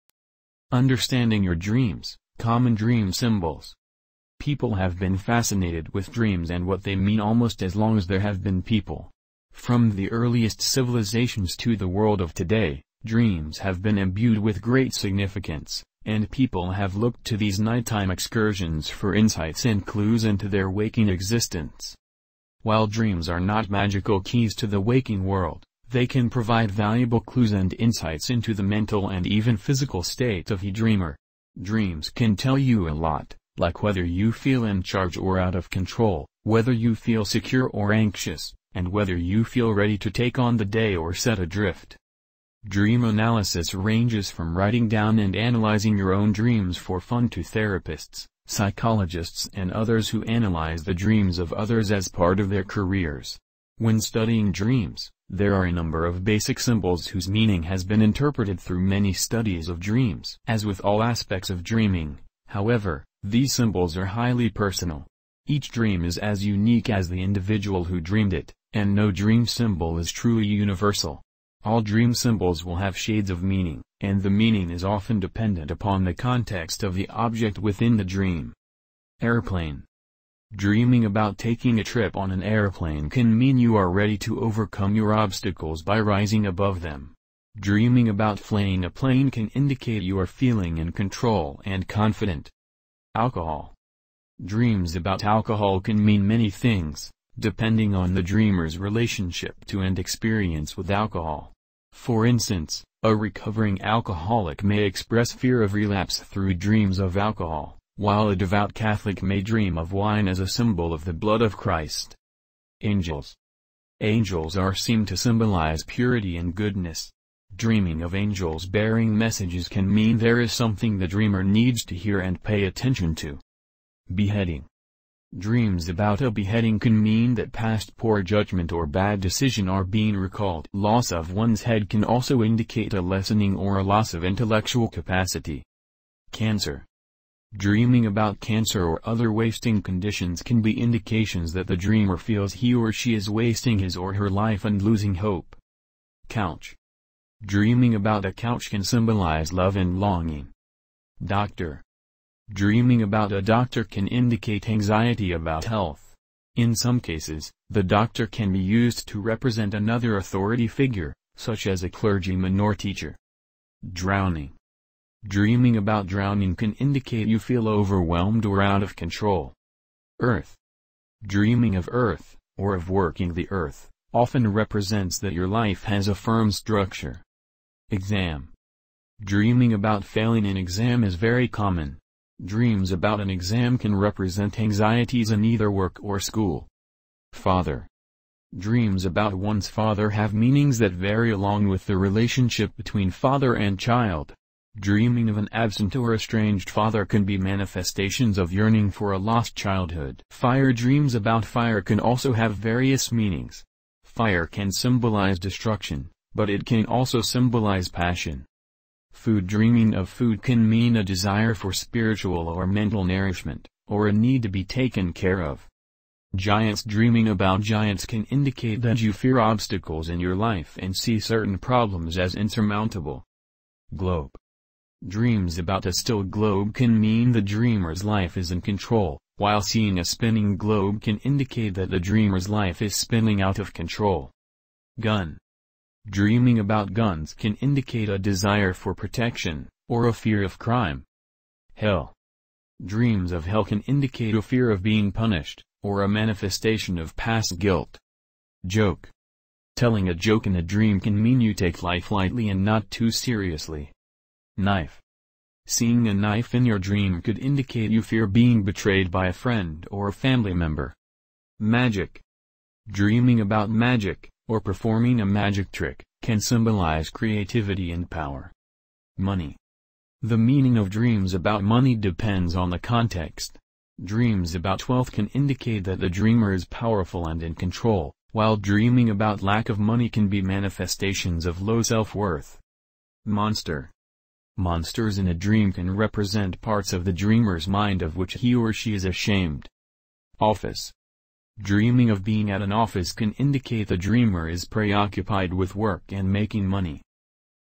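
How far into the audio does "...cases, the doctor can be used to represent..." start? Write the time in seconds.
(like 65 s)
157 s.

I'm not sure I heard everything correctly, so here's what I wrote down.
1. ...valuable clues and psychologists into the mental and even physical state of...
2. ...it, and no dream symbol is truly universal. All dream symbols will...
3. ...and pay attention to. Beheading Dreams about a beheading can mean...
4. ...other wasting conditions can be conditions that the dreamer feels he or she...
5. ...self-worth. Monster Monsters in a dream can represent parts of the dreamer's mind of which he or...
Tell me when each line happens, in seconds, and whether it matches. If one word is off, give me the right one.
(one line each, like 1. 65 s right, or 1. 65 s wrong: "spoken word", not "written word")
1. 26 s wrong: "insights", not "psychologists"
2. 68 s right
3. 122 s right
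4. 139 s wrong: "indications", not "conditions"
5. 281 s right.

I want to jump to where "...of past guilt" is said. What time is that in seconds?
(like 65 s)
246 s.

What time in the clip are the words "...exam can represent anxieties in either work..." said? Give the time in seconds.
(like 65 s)
183 s.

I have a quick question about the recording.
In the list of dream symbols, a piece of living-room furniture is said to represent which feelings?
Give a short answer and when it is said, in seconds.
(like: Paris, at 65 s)
love and longing, at 149 s.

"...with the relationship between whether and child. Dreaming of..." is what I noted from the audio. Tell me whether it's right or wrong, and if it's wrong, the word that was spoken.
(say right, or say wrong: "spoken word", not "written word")
wrong: "father", not "whether".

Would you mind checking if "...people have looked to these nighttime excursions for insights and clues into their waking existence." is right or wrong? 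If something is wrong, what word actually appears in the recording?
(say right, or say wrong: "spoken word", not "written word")
right.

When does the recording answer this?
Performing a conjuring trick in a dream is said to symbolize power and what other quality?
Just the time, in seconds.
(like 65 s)
267 s.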